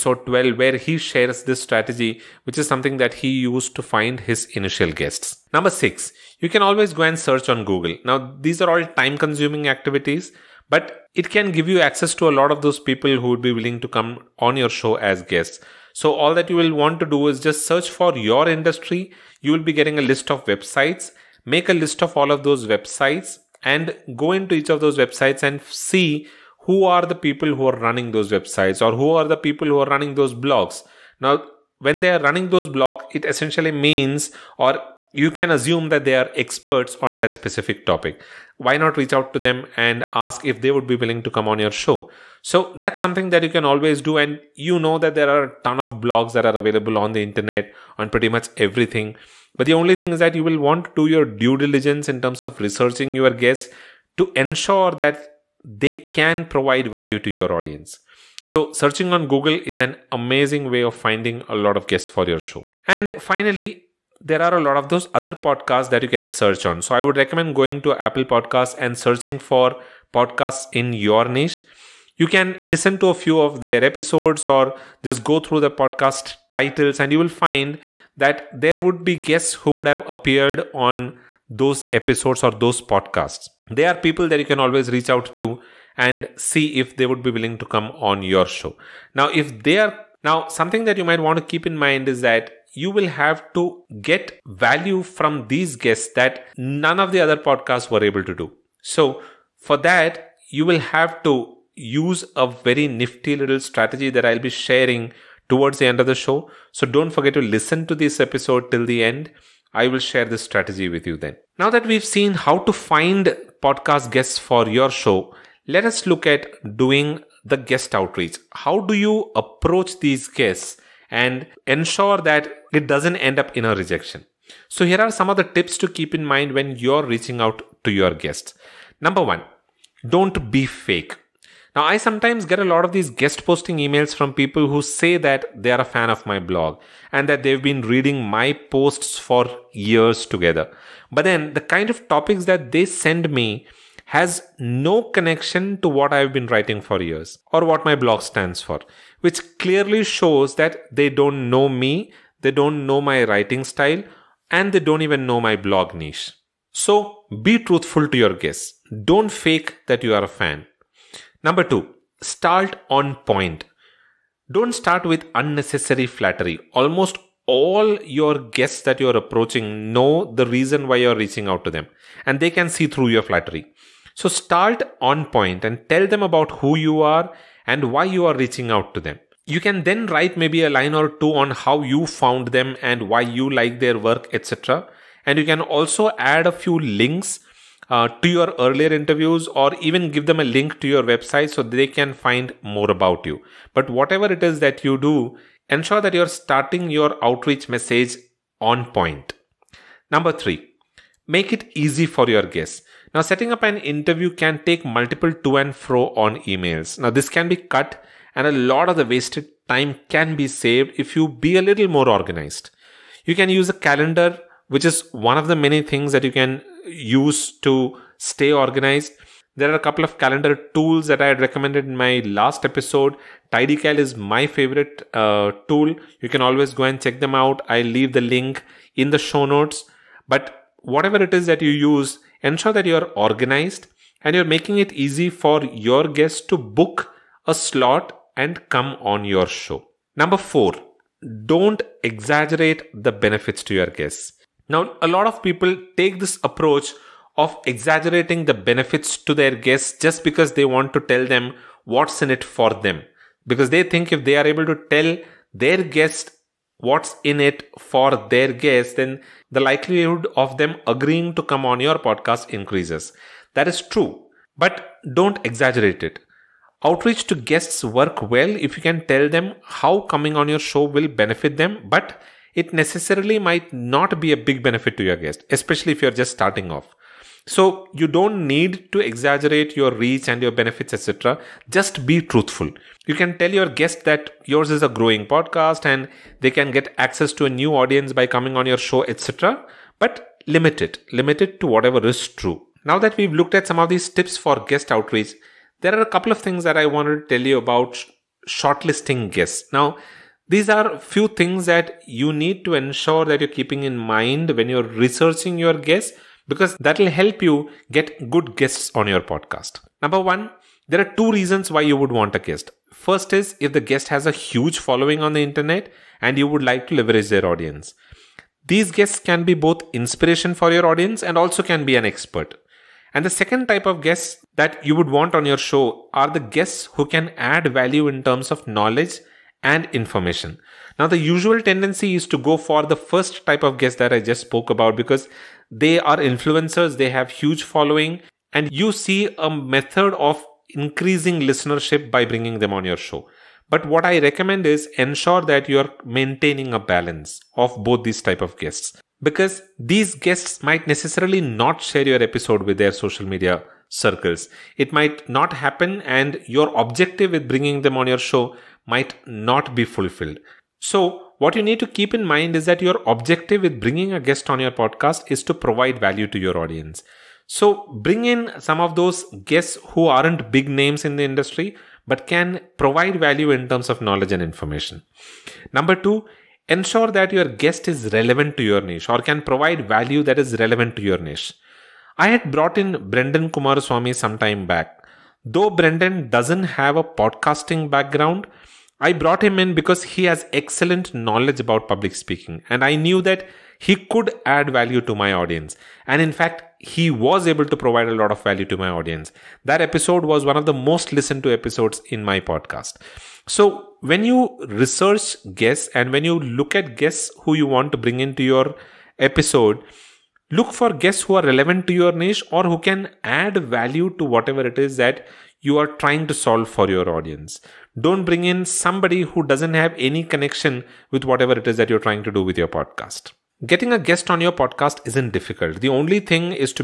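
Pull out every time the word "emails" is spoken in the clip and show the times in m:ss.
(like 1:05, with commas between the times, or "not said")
2:13, 3:26.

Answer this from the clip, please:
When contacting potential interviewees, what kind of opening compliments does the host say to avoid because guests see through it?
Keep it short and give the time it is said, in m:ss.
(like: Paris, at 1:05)
Unnecessary flattery, at 2:45.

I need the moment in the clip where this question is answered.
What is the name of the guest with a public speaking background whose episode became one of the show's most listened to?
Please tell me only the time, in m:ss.
6:23.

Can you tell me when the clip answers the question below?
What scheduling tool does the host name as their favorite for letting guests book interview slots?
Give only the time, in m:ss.
3:43.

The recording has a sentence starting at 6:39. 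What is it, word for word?
That episode was one of the most listened to episodes in my podcast.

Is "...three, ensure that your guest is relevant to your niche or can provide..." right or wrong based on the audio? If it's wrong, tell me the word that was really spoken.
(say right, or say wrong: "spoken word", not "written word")
wrong: "two", not "three".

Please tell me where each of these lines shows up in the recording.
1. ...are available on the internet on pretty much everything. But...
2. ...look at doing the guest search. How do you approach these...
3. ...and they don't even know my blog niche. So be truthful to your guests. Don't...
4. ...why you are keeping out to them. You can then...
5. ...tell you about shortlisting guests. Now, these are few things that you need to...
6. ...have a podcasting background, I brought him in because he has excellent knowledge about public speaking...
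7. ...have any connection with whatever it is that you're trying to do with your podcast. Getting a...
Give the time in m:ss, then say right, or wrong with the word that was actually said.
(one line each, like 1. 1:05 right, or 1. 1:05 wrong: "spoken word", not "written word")
1. 0:46 right
2. 1:56 wrong: "outreach", not "search"
3. 2:34 right
4. 2:57 wrong: "reaching", not "keeping"
5. 4:57 right
6. 6:26 right
7. 6:59 right.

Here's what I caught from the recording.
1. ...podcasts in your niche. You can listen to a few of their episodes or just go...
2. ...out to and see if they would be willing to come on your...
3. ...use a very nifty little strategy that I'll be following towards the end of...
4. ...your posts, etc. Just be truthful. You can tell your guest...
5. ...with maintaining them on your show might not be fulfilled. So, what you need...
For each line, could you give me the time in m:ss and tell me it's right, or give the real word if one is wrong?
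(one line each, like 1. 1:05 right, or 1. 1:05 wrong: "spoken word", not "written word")
1. 1:10 right
2. 1:25 right
3. 1:41 wrong: "sharing", not "following"
4. 4:40 wrong: "benefits", not "posts"
5. 5:57 wrong: "bringing", not "maintaining".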